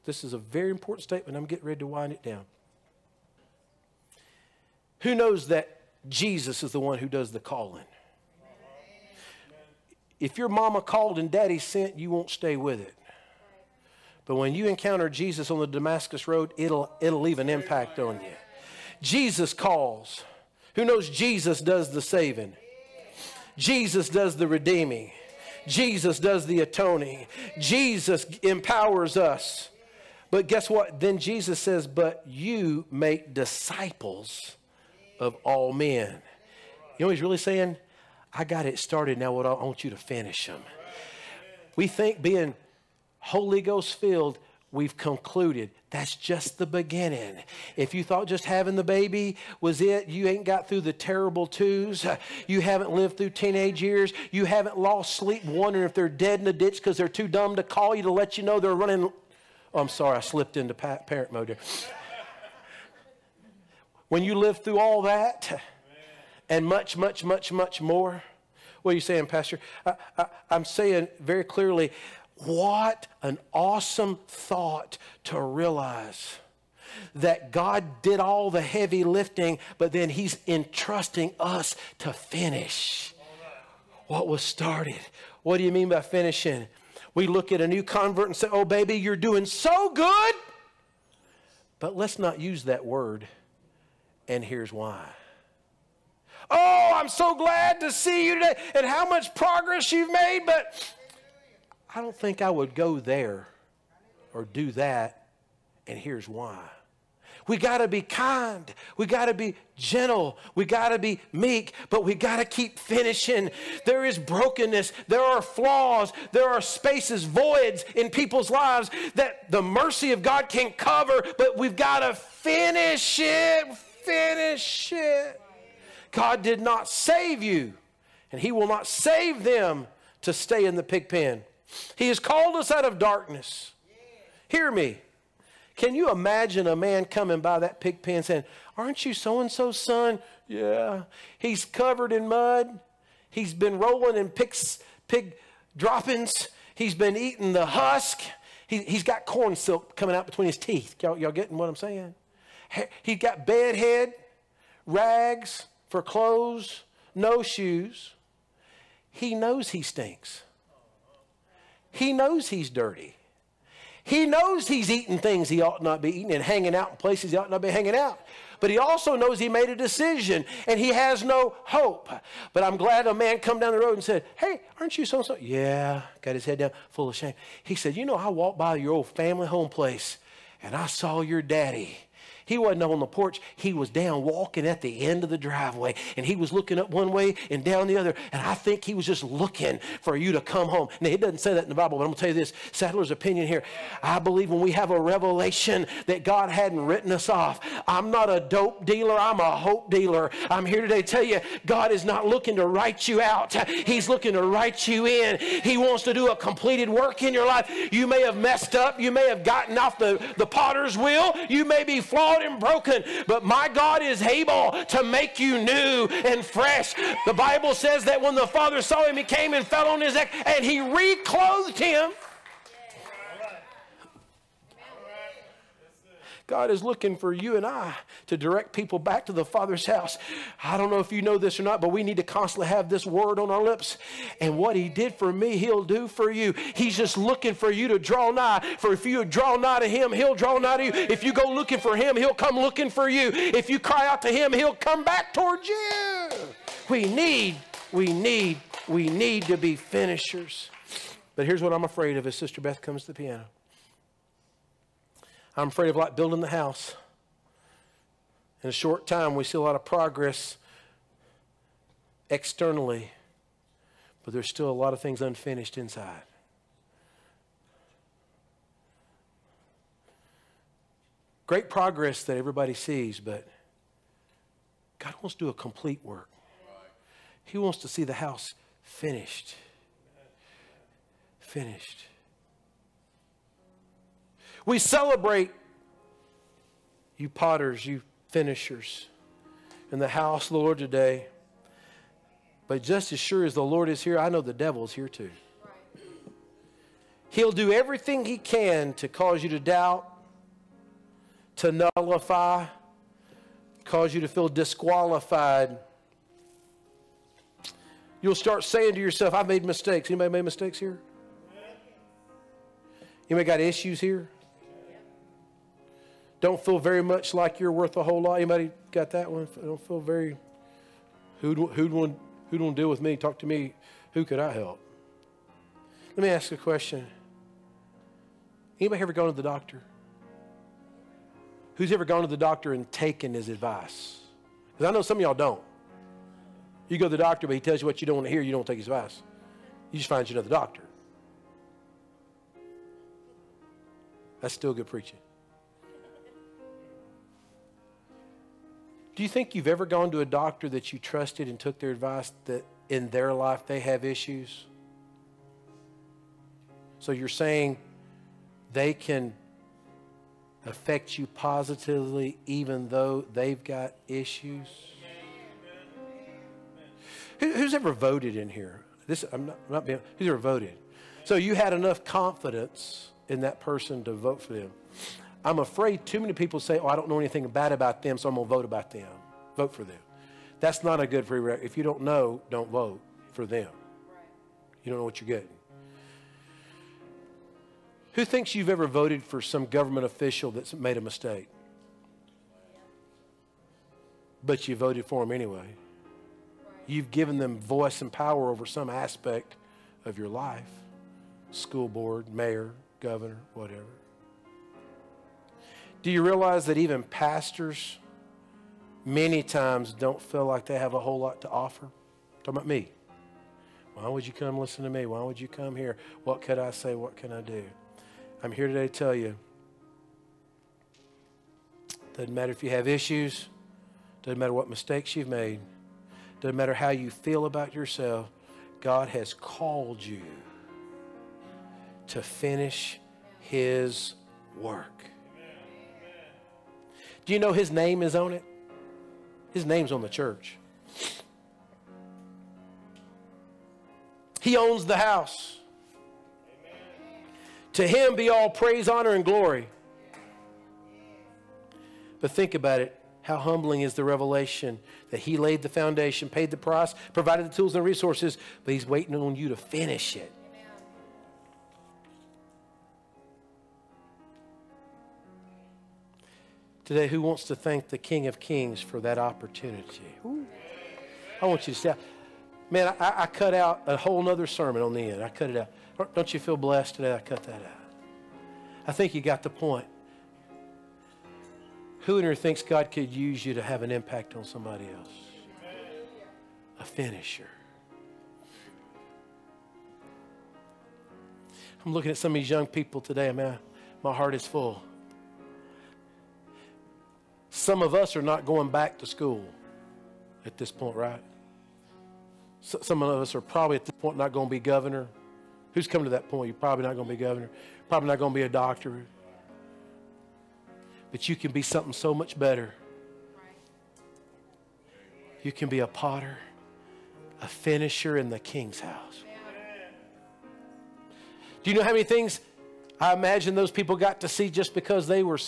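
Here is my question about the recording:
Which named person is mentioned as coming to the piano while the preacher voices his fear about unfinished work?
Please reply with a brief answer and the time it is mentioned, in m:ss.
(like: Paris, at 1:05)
Sister Beth, at 4:12.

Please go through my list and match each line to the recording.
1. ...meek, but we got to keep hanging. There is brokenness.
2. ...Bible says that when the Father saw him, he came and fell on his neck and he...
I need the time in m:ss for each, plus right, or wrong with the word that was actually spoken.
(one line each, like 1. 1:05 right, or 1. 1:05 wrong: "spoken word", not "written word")
1. 1:51 wrong: "finishing", not "hanging"
2. 3:37 right.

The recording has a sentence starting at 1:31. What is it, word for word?
But let's not use that word.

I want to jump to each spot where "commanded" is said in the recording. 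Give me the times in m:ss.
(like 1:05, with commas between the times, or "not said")
not said.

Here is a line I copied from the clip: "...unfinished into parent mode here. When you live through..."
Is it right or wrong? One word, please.
wrong.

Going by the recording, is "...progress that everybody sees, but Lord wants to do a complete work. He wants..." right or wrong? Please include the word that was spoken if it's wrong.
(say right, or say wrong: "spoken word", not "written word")
wrong: "God", not "Lord".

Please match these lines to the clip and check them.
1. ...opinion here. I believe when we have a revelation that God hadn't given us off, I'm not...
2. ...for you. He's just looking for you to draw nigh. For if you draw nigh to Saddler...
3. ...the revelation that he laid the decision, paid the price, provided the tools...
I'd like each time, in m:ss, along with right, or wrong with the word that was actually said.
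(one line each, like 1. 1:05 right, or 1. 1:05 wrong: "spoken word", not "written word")
1. 3:13 wrong: "written", not "given"
2. 3:56 wrong: "Him", not "Saddler"
3. 7:33 wrong: "foundation", not "decision".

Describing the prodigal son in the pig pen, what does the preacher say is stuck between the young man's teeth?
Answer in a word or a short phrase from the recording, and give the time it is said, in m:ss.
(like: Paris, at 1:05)
corn silk, at 2:29.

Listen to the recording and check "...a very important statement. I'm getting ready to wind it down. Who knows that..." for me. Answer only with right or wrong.
right.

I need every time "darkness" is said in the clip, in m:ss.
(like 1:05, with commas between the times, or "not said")
2:12.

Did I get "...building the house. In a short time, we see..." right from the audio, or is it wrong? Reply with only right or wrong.
right.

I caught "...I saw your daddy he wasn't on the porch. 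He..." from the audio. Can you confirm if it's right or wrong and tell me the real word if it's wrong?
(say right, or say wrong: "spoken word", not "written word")
right.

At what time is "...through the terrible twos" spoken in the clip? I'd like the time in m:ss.
0:50.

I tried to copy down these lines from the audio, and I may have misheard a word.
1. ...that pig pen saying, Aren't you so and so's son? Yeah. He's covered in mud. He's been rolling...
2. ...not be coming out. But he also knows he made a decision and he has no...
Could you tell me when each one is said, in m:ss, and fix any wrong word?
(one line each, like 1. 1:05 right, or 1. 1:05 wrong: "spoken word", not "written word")
1. 2:17 right
2. 2:47 wrong: "hanging", not "coming".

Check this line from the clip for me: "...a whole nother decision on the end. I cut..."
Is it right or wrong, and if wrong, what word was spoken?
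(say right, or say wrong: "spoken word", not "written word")
wrong: "sermon", not "decision".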